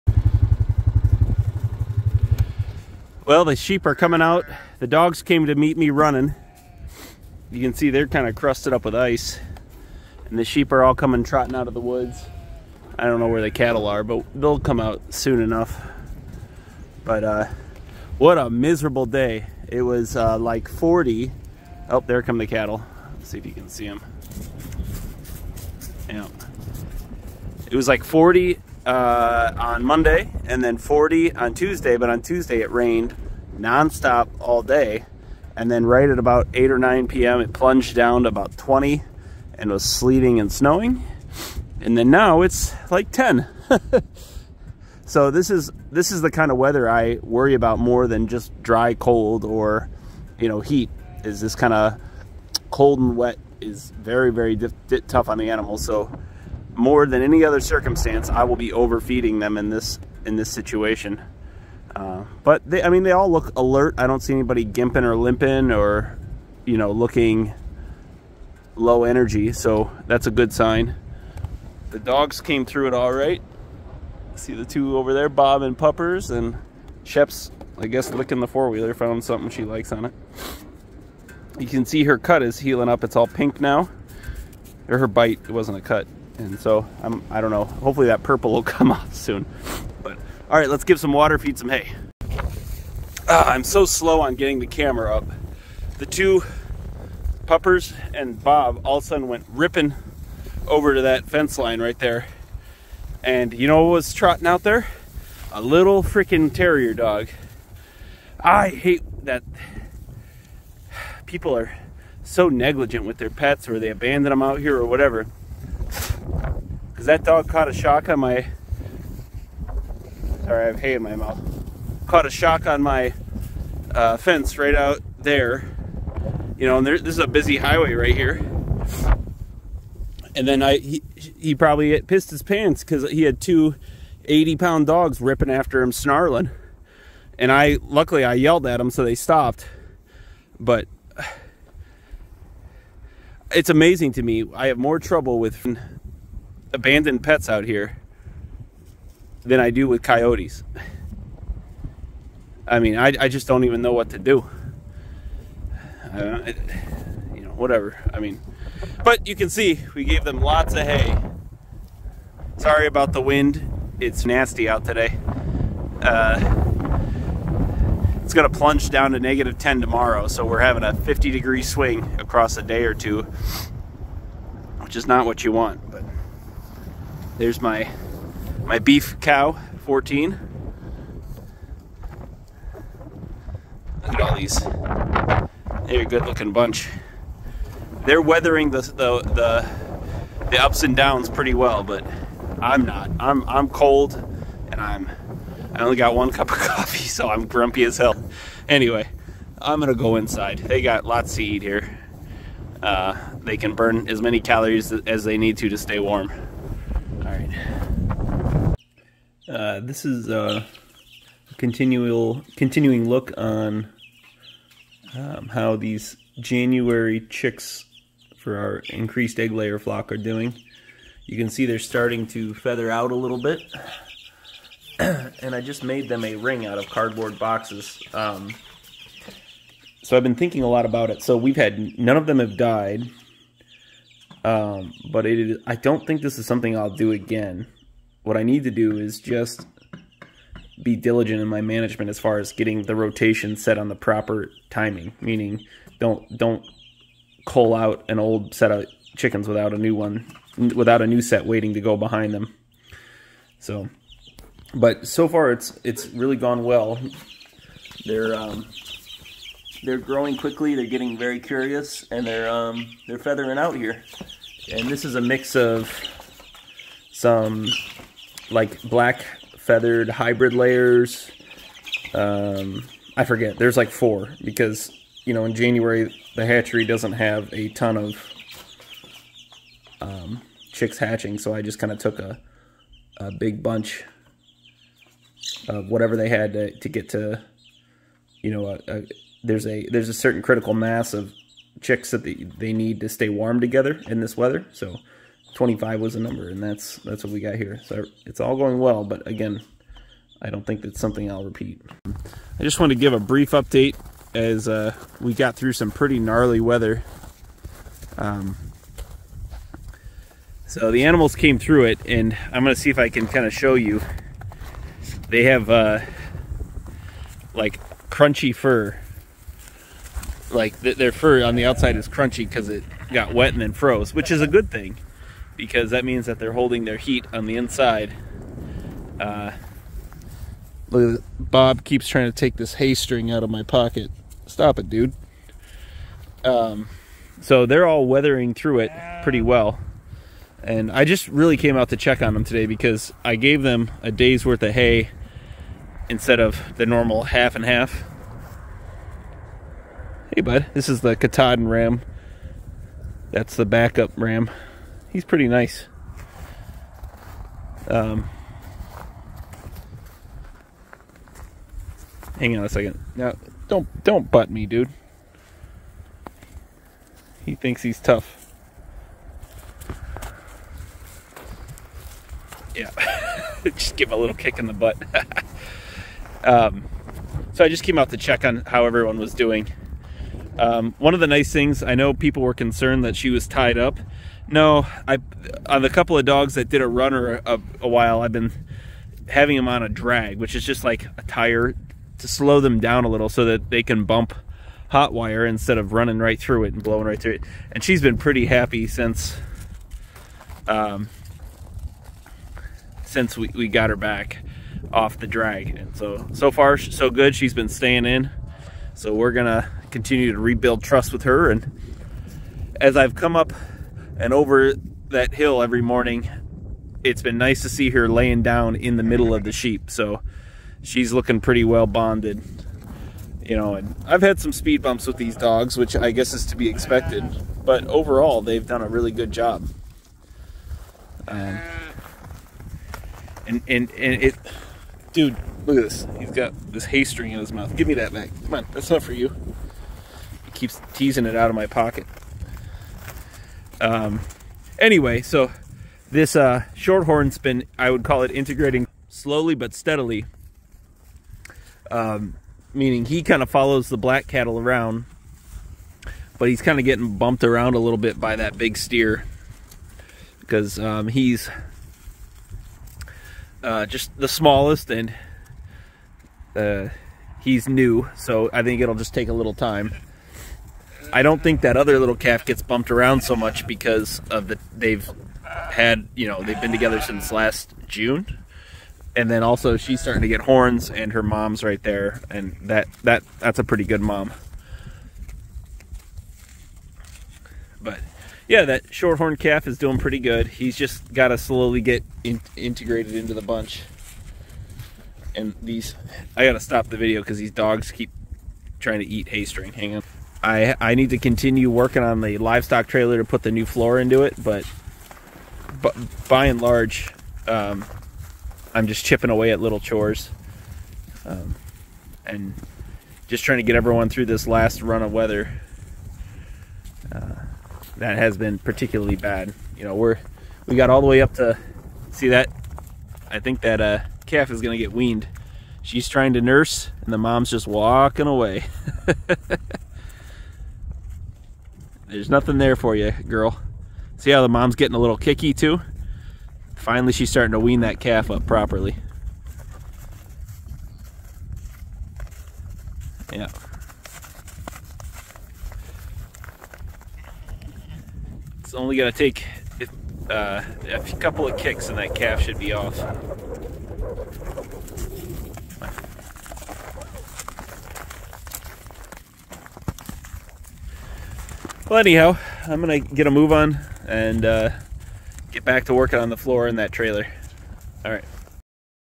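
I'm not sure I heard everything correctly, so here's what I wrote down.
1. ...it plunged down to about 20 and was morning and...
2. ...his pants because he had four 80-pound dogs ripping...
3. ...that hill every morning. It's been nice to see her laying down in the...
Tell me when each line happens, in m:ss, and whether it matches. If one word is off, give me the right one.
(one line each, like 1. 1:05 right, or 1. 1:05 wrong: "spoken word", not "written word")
1. 0:37 wrong: "sleeting", not "morning"
2. 2:12 wrong: "two", not "four"
3. 6:55 right.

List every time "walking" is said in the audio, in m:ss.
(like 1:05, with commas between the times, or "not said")
8:47.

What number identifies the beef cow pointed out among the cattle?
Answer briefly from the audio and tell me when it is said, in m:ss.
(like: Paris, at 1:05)
14, at 2:59.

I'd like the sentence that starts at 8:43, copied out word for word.
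I think that uh, calf is gonna get weaned.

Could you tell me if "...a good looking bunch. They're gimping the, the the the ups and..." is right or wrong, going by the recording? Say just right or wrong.
wrong.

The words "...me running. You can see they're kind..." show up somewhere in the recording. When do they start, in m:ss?
0:05.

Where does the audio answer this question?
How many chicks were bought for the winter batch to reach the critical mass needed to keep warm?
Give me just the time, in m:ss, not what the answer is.
4:55.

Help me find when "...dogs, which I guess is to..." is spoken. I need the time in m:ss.
7:05.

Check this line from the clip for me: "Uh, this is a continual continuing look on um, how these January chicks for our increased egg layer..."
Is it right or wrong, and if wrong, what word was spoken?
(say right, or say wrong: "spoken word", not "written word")
right.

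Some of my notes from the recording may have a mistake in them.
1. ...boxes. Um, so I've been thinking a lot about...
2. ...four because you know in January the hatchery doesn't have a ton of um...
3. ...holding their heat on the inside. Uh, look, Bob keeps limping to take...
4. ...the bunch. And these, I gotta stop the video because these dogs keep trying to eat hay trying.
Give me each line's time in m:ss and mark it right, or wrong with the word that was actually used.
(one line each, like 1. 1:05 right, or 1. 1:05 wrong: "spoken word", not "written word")
1. 3:47 right
2. 4:33 right
3. 5:26 wrong: "trying", not "limping"
4. 8:13 wrong: "string", not "trying".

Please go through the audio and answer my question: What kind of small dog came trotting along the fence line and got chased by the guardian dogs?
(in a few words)
Terrier.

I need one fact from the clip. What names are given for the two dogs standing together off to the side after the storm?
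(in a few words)
Bob and Puppers.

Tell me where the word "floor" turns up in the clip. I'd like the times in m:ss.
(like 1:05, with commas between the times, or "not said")
8:23, 9:26.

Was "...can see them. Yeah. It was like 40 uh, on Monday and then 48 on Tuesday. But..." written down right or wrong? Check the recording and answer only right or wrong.
wrong.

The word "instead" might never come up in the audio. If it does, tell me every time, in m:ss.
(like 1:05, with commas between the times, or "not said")
5:46, 6:35.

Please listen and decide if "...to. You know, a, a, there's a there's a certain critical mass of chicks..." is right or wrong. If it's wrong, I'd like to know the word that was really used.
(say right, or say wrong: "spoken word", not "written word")
right.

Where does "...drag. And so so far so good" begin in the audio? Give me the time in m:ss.
6:45.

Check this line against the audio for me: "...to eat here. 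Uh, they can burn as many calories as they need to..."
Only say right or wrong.
right.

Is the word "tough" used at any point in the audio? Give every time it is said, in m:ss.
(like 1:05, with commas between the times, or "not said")
0:55, 6:07.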